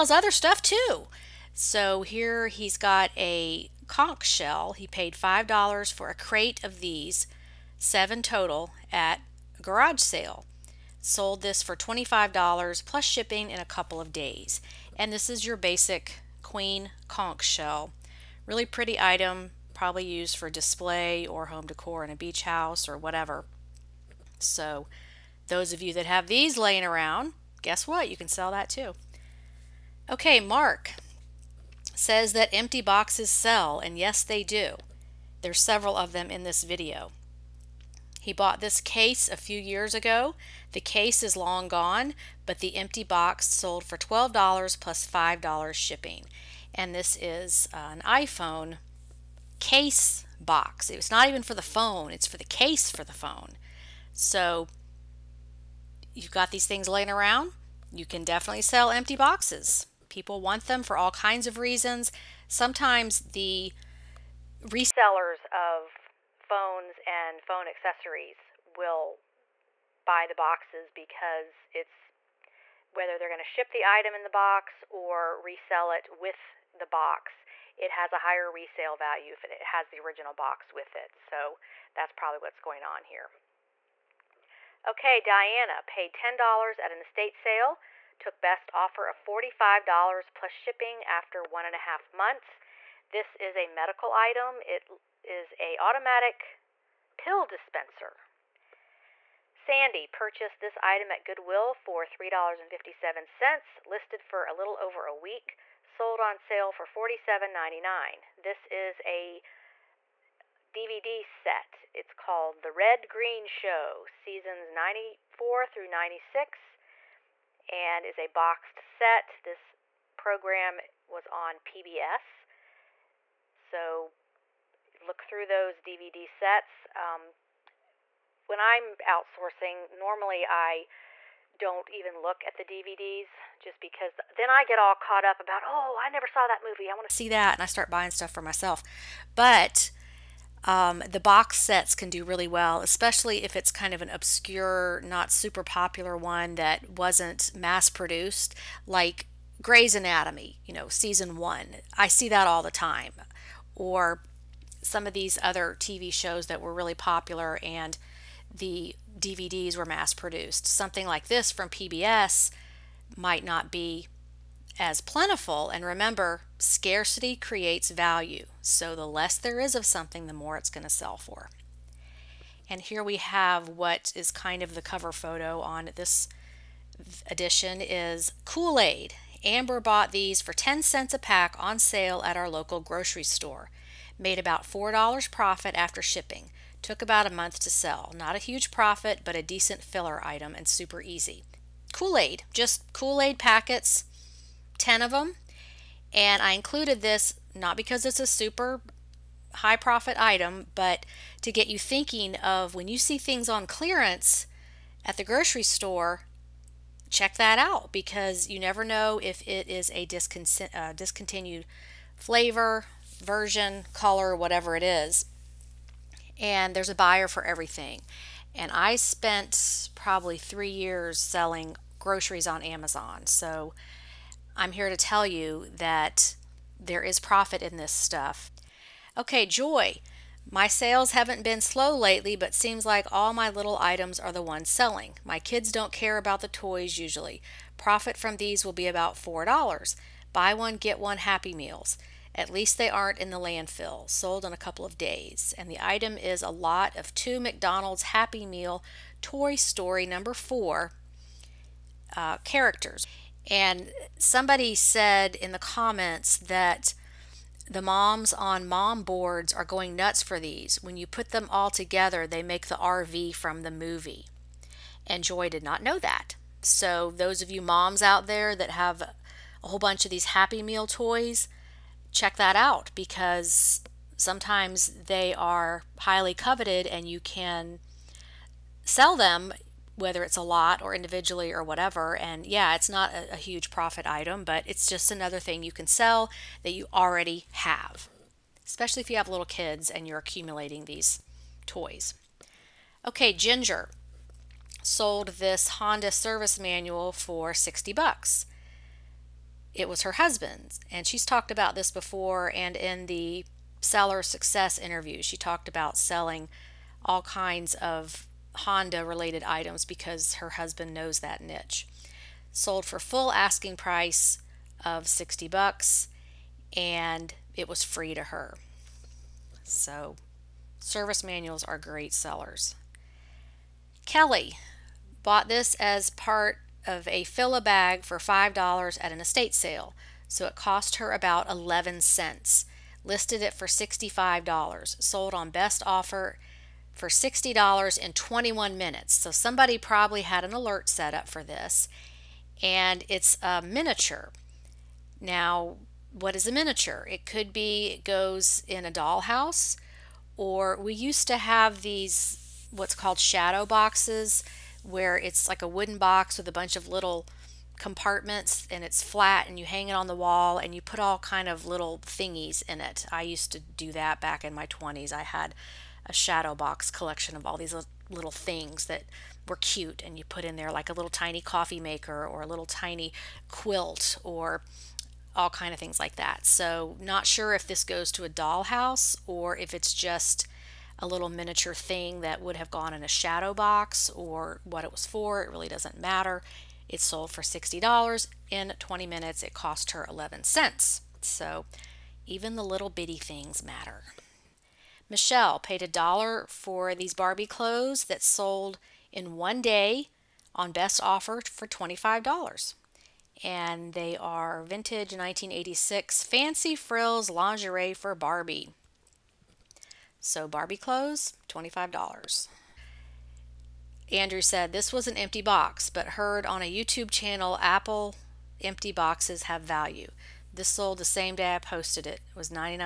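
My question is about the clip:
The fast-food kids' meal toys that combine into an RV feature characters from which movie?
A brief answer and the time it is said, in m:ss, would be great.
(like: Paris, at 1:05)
Toy Story, at 4:09.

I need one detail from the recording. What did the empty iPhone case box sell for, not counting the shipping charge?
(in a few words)
$12.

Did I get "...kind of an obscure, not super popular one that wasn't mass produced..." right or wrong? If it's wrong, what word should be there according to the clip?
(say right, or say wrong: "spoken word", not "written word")
right.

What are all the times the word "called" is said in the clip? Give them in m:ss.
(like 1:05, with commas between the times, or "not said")
1:52, 5:52.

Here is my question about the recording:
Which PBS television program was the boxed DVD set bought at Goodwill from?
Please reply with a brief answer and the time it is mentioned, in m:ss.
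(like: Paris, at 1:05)
The Red Green Show, at 1:52.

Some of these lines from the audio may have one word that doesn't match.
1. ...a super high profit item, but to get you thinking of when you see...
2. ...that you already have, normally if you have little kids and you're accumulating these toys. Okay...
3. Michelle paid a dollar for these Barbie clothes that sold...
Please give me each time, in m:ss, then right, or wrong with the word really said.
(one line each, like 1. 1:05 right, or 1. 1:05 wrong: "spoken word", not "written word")
1. 3:18 right
2. 4:46 wrong: "especially", not "normally"
3. 6:35 right.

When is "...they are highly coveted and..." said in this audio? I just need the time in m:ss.
4:35.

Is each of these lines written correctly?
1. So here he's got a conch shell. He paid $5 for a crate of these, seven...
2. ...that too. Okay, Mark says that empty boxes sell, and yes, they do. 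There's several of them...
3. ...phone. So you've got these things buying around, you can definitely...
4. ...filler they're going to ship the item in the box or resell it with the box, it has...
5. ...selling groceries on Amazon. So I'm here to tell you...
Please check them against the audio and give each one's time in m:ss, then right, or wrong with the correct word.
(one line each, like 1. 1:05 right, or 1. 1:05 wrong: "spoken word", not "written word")
1. 0:01 right
2. 0:28 right
3. 0:53 wrong: "laying", not "buying"
4. 1:12 wrong: "whether", not "filler"
5. 3:41 right.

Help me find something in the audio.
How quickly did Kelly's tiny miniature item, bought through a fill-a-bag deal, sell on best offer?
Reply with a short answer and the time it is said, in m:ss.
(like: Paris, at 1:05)
21 minutes, at 5:38.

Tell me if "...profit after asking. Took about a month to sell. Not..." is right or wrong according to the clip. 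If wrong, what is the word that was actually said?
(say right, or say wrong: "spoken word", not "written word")
wrong: "shipping", not "asking".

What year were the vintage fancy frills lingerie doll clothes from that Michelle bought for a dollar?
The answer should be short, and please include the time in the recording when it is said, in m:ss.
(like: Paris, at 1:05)
1986, at 6:45.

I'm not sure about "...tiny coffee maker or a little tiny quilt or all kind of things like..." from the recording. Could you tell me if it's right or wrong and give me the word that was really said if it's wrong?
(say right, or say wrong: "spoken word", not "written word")
right.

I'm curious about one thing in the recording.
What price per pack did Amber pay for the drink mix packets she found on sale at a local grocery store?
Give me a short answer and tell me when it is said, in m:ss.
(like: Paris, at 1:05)
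10 cents, at 3:00.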